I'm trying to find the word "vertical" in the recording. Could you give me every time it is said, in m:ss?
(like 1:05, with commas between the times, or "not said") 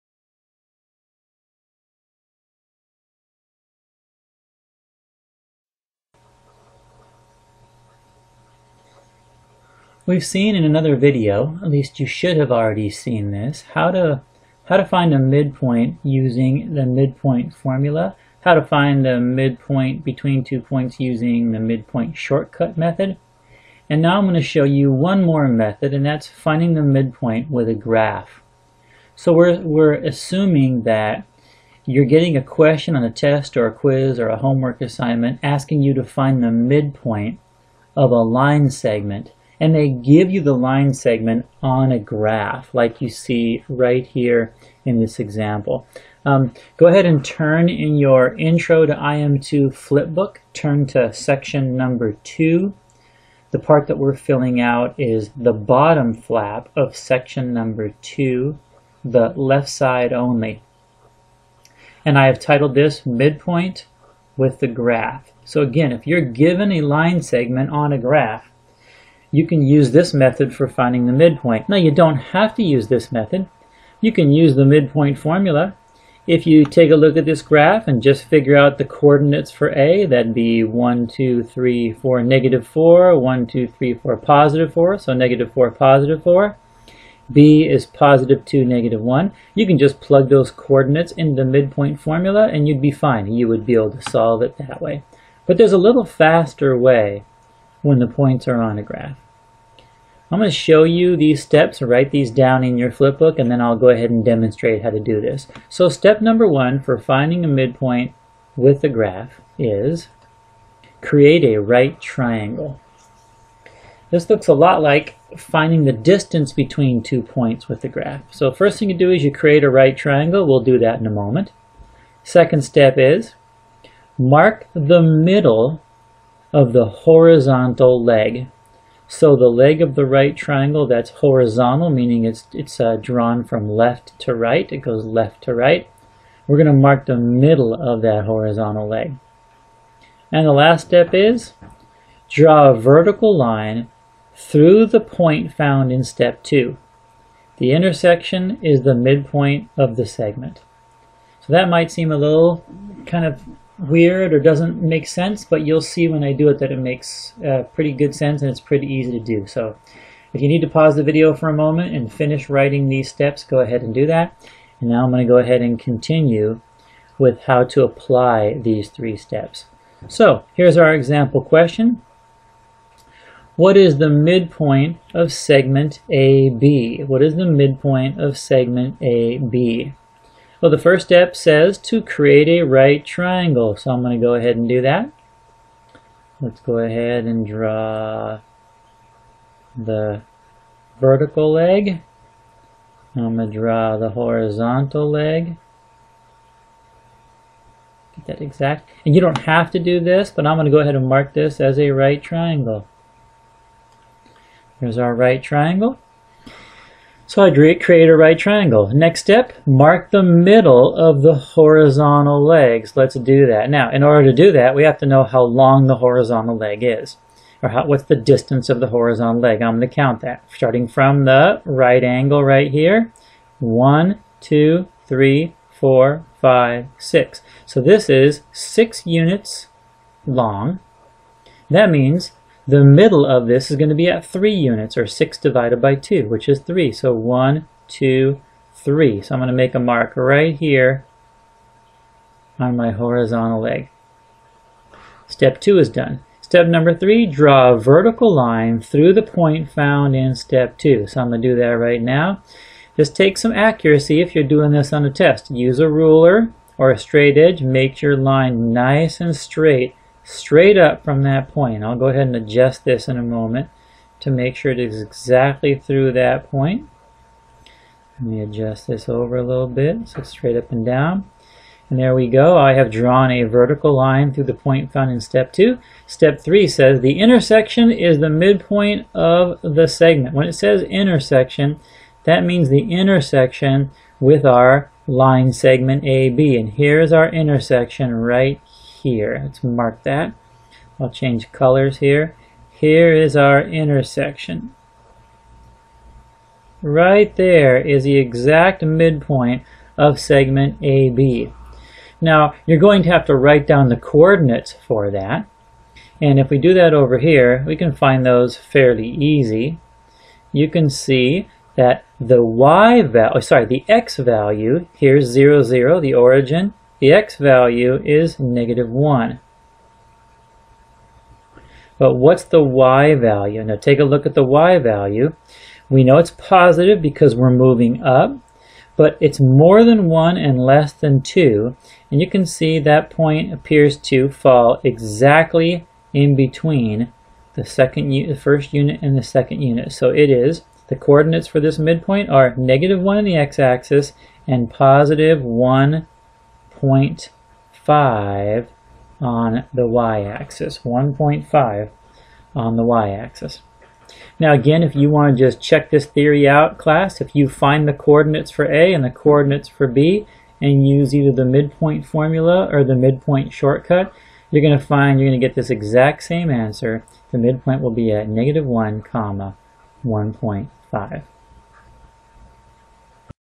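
2:22, 3:10, 4:07, 4:33.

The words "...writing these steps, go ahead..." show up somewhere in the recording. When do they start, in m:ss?
2:42.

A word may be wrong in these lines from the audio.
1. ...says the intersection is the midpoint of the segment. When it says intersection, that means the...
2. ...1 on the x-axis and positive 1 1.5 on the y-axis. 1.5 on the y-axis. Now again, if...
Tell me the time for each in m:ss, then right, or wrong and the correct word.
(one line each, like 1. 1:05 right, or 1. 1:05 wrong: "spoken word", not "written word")
1. 4:36 right
2. 5:43 right.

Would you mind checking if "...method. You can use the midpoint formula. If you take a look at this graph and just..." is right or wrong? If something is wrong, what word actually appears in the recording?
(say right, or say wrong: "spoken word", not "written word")
right.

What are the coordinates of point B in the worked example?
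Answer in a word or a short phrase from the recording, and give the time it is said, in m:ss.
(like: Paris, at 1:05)
(2, -1), at 1:27.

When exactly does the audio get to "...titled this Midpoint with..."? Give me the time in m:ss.
1:02.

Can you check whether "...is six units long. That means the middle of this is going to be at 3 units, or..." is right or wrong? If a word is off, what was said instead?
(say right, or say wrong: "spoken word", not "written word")
right.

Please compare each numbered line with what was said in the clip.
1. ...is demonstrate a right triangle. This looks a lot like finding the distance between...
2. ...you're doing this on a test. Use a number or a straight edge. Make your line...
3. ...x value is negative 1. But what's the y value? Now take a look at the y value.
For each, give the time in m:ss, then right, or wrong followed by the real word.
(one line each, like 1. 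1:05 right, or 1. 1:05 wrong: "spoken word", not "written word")
1. 1:49 wrong: "create", not "demonstrate"
2. 4:14 wrong: "ruler", not "number"
3. 5:17 right.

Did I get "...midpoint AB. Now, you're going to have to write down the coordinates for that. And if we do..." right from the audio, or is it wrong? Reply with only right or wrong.
wrong.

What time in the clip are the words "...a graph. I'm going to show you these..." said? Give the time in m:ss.
1:38.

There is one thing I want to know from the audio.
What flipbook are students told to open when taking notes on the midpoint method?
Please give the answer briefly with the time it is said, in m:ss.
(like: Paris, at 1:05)
Intro to IM2, at 0:48.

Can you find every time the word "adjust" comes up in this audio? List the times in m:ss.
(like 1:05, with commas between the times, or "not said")
4:22, 4:28.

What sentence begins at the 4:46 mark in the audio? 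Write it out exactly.
And here's our intersection right here.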